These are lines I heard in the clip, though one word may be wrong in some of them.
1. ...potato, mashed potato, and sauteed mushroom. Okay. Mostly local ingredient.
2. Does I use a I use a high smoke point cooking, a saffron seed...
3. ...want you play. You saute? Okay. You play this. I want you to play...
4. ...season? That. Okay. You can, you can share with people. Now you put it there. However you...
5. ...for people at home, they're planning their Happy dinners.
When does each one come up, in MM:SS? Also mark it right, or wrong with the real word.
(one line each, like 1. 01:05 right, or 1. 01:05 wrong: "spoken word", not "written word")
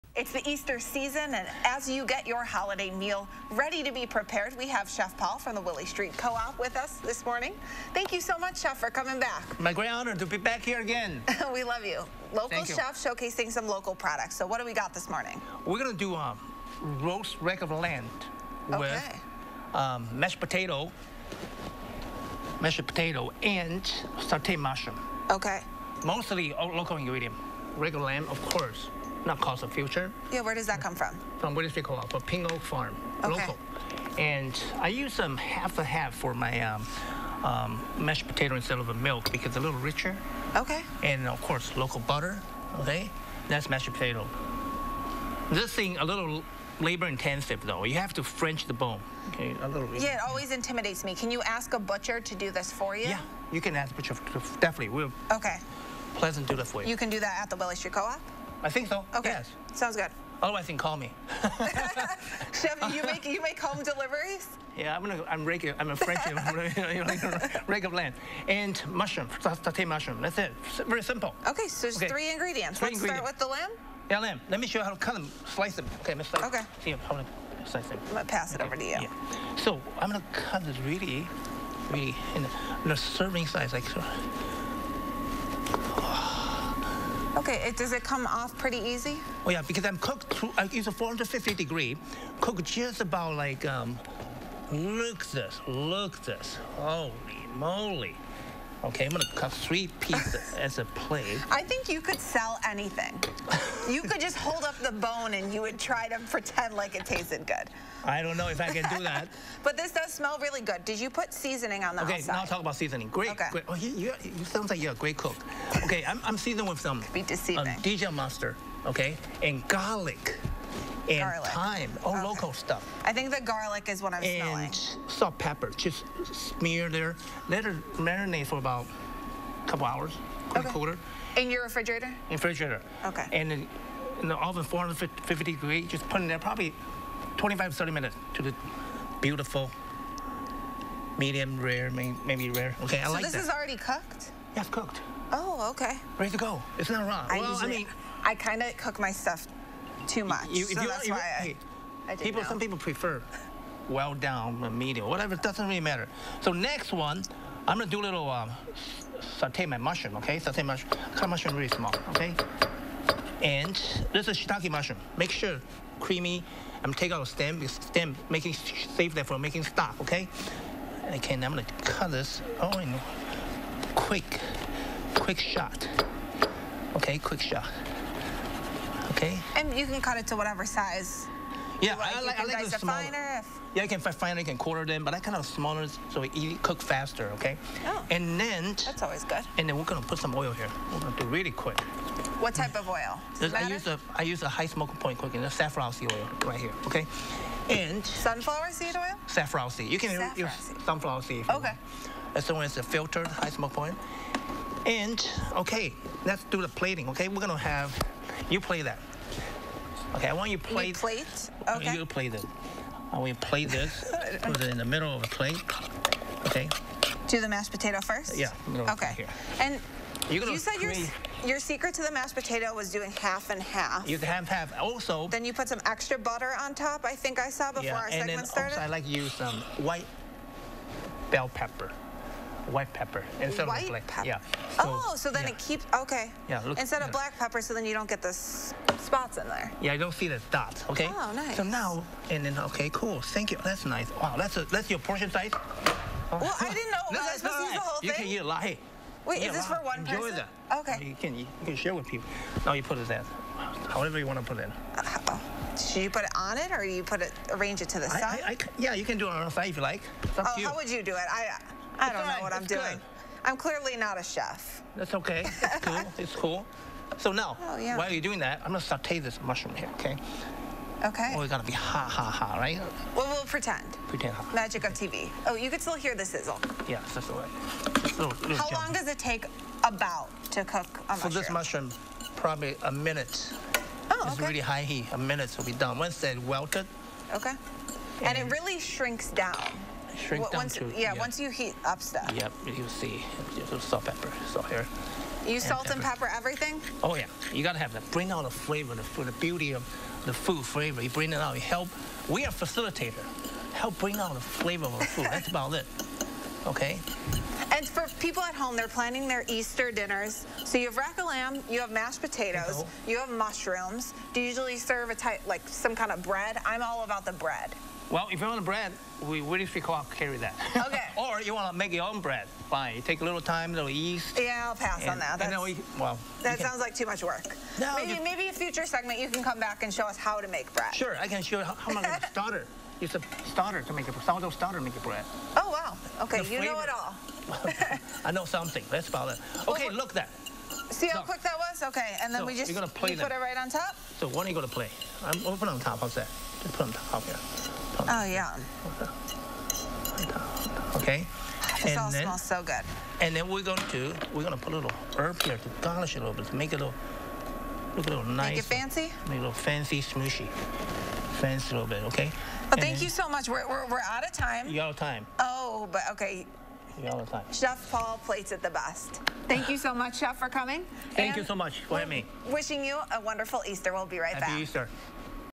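1. 00:20 right
2. 03:13 right
3. 03:30 wrong: "plate", not "saute"
4. 04:10 wrong: "person", not "season"
5. 05:07 wrong: "Easter", not "Happy".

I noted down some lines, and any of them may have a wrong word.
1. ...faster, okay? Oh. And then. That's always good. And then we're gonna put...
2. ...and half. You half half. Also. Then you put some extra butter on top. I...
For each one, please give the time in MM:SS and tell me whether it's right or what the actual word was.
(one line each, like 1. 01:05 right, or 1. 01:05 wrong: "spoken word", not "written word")
1. 03:06 right
2. 03:43 right.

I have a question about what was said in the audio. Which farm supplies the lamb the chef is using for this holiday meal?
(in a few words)
Ping Oak Farm.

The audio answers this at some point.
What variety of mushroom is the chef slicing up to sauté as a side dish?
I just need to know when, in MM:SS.
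02:44.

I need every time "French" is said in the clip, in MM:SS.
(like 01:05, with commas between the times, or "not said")
00:48, 01:05.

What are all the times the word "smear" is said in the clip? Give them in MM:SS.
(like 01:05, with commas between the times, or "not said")
02:06.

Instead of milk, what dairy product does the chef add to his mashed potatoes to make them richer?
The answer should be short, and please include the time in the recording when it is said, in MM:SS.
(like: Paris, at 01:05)
half and half, at 00:35.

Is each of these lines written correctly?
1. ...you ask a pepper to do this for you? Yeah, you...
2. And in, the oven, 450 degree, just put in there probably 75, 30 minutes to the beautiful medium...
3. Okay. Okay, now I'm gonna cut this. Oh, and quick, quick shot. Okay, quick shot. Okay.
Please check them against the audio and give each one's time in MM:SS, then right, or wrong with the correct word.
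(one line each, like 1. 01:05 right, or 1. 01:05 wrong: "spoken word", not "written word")
1. 00:51 wrong: "butcher", not "pepper"
2. 02:13 wrong: "25", not "75"
3. 02:50 right.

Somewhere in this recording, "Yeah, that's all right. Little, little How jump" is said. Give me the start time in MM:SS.
04:36.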